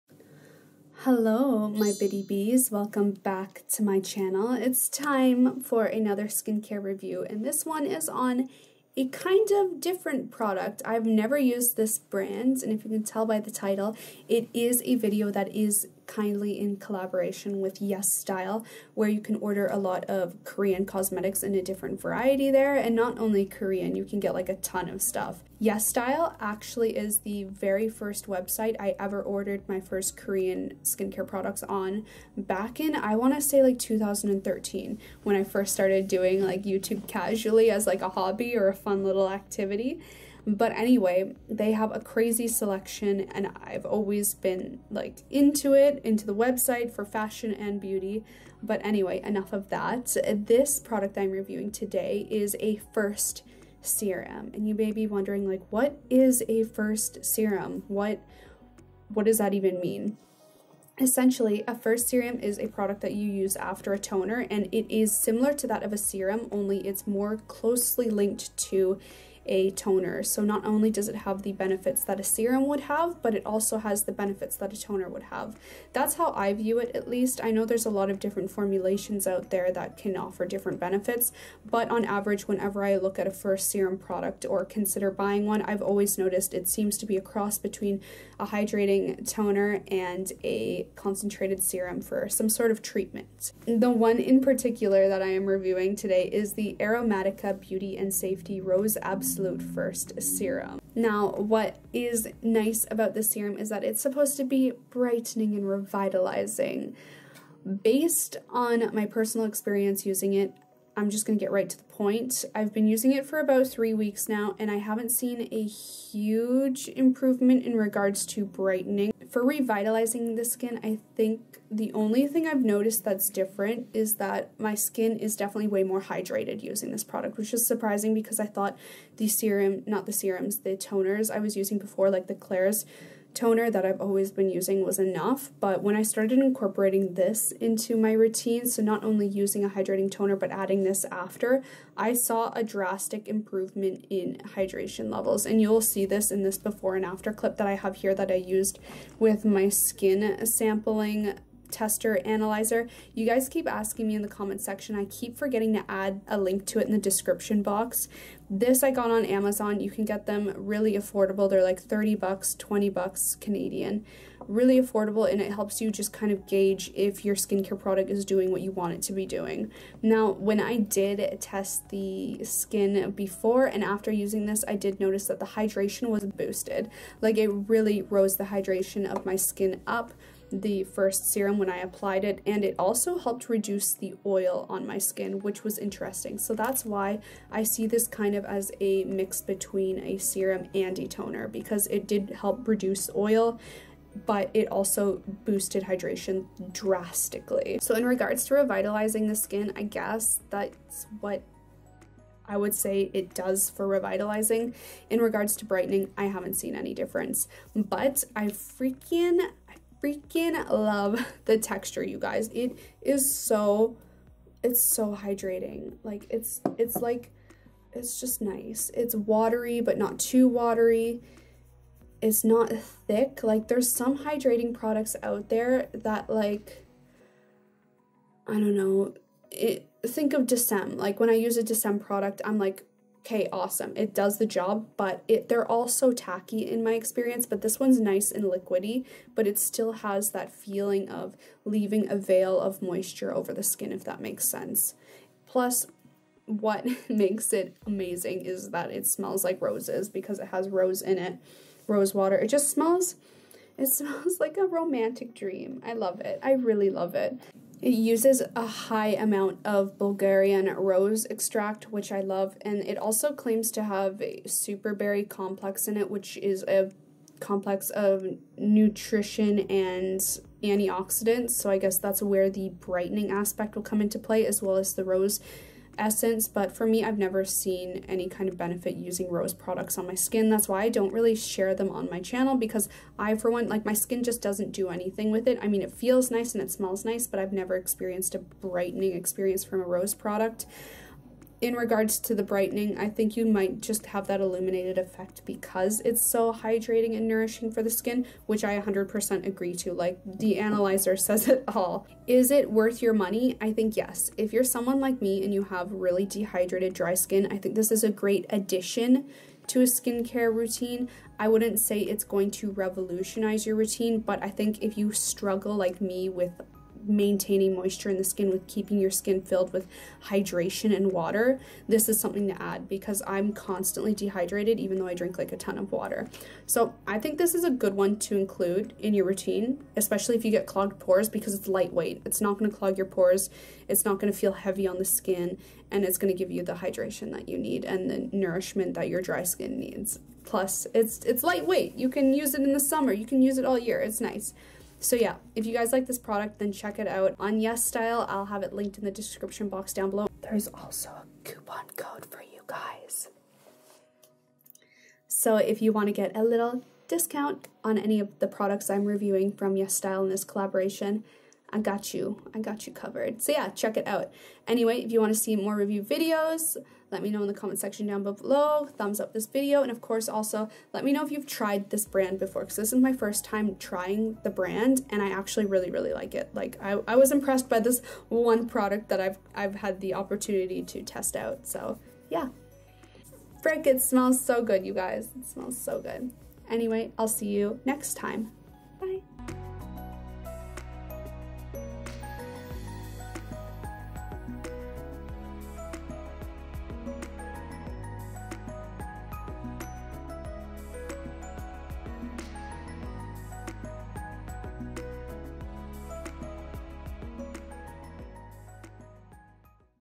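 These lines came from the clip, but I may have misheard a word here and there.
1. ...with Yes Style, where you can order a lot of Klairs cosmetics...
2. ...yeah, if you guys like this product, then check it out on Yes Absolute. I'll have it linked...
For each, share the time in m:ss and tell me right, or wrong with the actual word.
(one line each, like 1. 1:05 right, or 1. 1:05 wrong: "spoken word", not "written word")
1. 0:17 wrong: "Korean", not "Klairs"
2. 5:45 wrong: "Style", not "Absolute".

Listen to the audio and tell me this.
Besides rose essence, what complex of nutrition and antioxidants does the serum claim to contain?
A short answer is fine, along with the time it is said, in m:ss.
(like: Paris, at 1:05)
super berry complex, at 4:24.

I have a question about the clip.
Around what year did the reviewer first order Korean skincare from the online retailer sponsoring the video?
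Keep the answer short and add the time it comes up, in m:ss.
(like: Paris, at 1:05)
2013, at 0:33.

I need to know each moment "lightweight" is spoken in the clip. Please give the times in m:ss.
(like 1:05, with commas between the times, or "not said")
5:31, 5:41.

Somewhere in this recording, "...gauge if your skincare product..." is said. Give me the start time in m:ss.
2:46.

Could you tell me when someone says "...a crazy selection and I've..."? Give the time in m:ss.
0:41.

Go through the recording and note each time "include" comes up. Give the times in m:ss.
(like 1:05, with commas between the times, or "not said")
5:28.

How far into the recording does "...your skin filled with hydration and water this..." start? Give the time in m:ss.
5:18.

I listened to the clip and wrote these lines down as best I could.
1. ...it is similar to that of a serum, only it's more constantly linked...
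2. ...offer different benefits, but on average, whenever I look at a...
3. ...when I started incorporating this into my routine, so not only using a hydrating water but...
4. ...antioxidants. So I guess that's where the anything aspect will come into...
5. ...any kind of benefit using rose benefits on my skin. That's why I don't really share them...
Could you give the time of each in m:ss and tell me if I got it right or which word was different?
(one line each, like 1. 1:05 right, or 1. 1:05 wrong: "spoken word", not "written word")
1. 1:04 wrong: "closely", not "constantly"
2. 1:20 right
3. 2:15 wrong: "toner", not "water"
4. 4:30 wrong: "brightening", not "anything"
5. 4:38 wrong: "products", not "benefits".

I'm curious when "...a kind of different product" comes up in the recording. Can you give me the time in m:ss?
0:08.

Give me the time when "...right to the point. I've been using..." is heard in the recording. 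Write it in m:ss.
1:51.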